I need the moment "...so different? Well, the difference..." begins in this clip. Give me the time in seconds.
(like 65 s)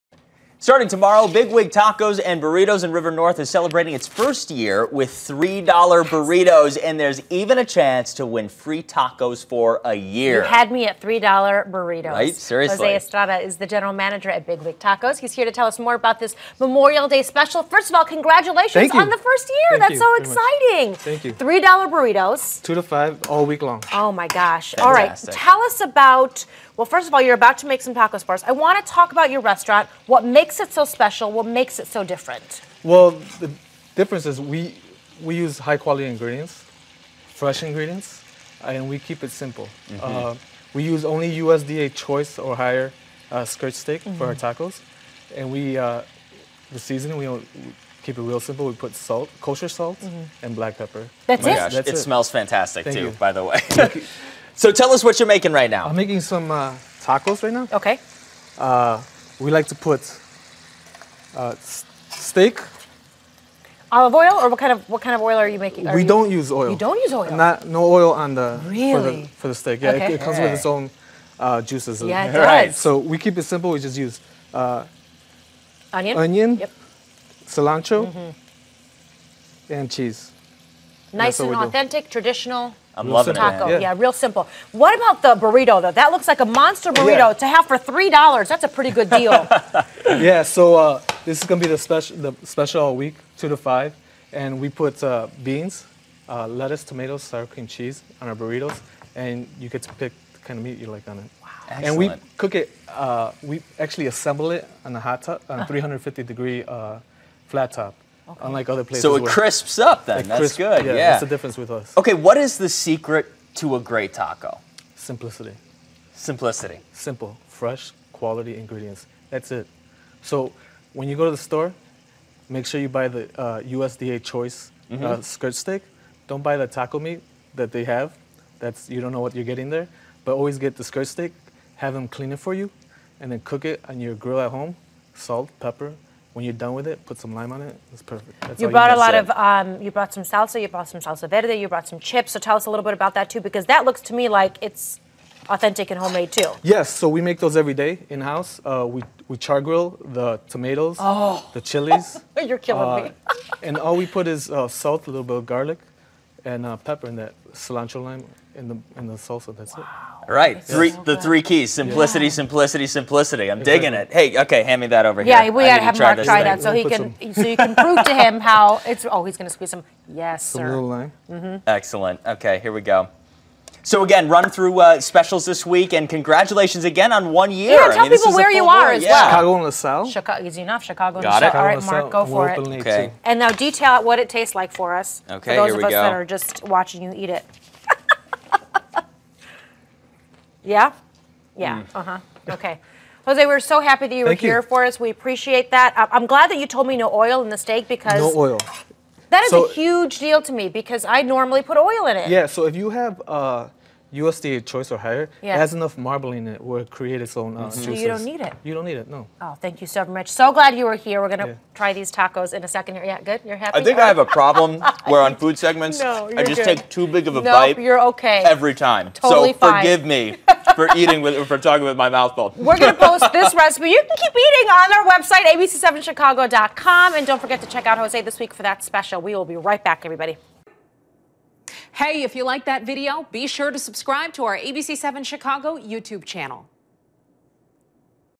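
31 s.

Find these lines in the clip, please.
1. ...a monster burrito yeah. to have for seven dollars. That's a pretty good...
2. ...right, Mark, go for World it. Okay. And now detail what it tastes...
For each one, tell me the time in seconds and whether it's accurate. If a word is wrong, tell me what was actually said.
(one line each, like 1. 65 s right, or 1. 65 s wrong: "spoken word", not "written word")
1. 86 s wrong: "three", not "seven"
2. 181 s right.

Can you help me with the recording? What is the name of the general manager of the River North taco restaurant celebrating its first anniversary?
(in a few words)
Jose Estrada.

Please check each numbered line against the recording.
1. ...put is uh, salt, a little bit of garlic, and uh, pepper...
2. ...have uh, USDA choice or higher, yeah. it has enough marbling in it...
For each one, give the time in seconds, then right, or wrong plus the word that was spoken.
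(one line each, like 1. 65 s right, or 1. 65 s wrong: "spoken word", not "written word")
1. 154 s right
2. 202 s right.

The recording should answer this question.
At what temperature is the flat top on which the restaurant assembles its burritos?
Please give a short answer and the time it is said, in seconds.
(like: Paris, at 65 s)
350 degrees, at 105 s.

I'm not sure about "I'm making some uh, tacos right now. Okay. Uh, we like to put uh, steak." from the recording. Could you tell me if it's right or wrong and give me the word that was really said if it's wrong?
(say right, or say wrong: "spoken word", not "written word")
right.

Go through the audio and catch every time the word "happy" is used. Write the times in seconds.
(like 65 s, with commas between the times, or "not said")
193 s, 213 s.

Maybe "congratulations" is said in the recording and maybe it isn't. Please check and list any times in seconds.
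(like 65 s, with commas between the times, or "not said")
18 s, 176 s.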